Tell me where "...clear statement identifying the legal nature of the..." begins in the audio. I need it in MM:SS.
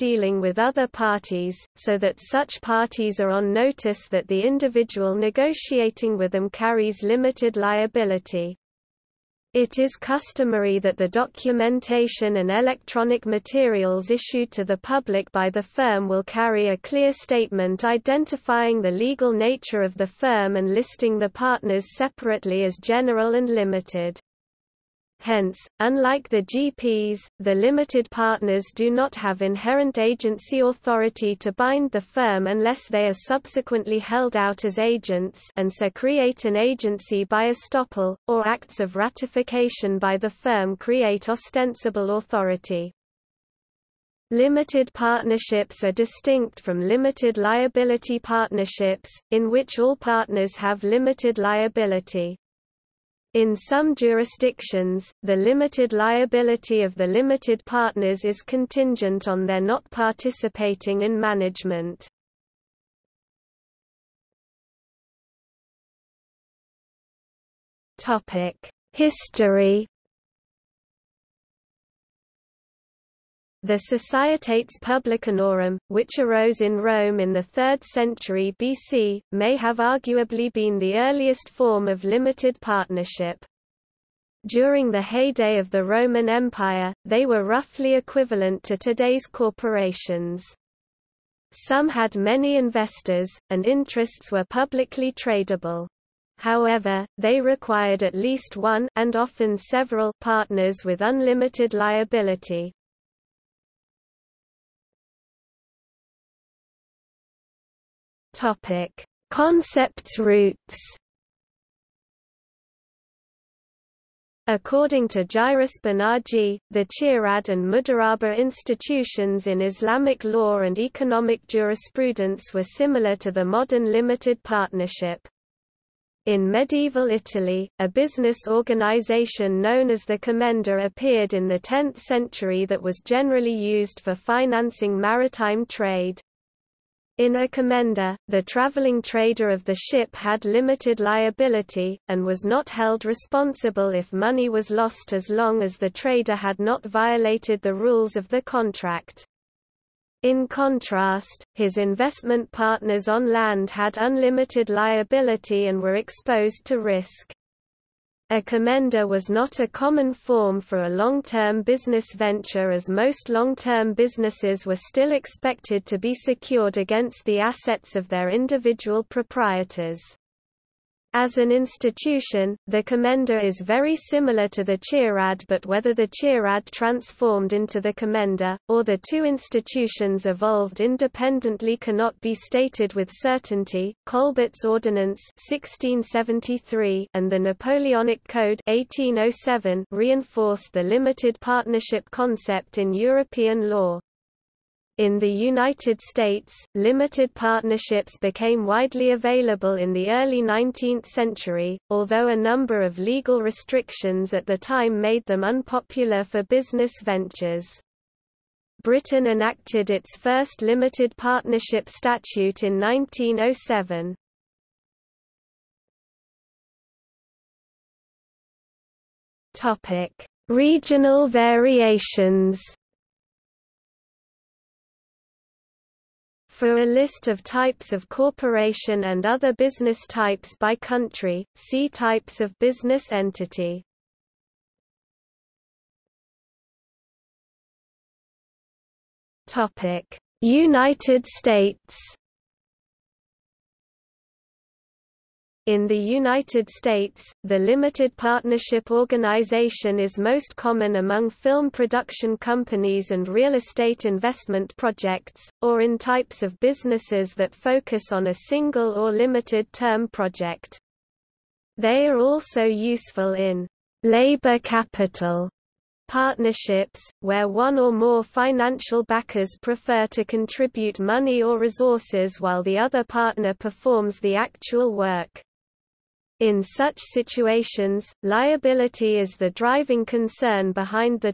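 00:16.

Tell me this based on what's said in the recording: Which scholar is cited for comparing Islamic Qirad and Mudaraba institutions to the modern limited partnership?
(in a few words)
Jairus Banaji.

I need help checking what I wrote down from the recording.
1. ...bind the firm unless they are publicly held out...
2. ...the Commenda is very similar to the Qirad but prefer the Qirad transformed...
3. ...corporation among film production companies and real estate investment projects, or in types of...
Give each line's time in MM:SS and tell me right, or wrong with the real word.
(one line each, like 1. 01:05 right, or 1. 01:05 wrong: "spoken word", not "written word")
1. 00:31 wrong: "subsequently", not "publicly"
2. 02:52 wrong: "whether", not "prefer"
3. 04:10 wrong: "common", not "corporation".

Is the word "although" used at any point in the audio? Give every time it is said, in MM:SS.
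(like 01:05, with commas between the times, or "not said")
03:21.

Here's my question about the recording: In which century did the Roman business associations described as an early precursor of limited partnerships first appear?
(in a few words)
3rd century BC.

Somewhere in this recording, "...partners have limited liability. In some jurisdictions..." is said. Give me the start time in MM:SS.
00:49.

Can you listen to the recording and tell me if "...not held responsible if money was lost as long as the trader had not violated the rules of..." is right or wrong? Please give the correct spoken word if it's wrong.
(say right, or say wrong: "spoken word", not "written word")
right.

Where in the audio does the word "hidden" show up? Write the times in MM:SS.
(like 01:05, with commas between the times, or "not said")
not said.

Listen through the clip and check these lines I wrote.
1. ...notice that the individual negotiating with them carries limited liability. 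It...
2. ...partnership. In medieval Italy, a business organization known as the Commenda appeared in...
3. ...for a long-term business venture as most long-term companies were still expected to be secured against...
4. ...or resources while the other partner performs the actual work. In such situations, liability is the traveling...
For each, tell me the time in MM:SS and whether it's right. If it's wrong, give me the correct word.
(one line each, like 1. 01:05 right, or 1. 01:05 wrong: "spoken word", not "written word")
1. 00:03 right
2. 02:04 right
3. 02:40 wrong: "businesses", not "companies"
4. 04:31 wrong: "driving", not "traveling".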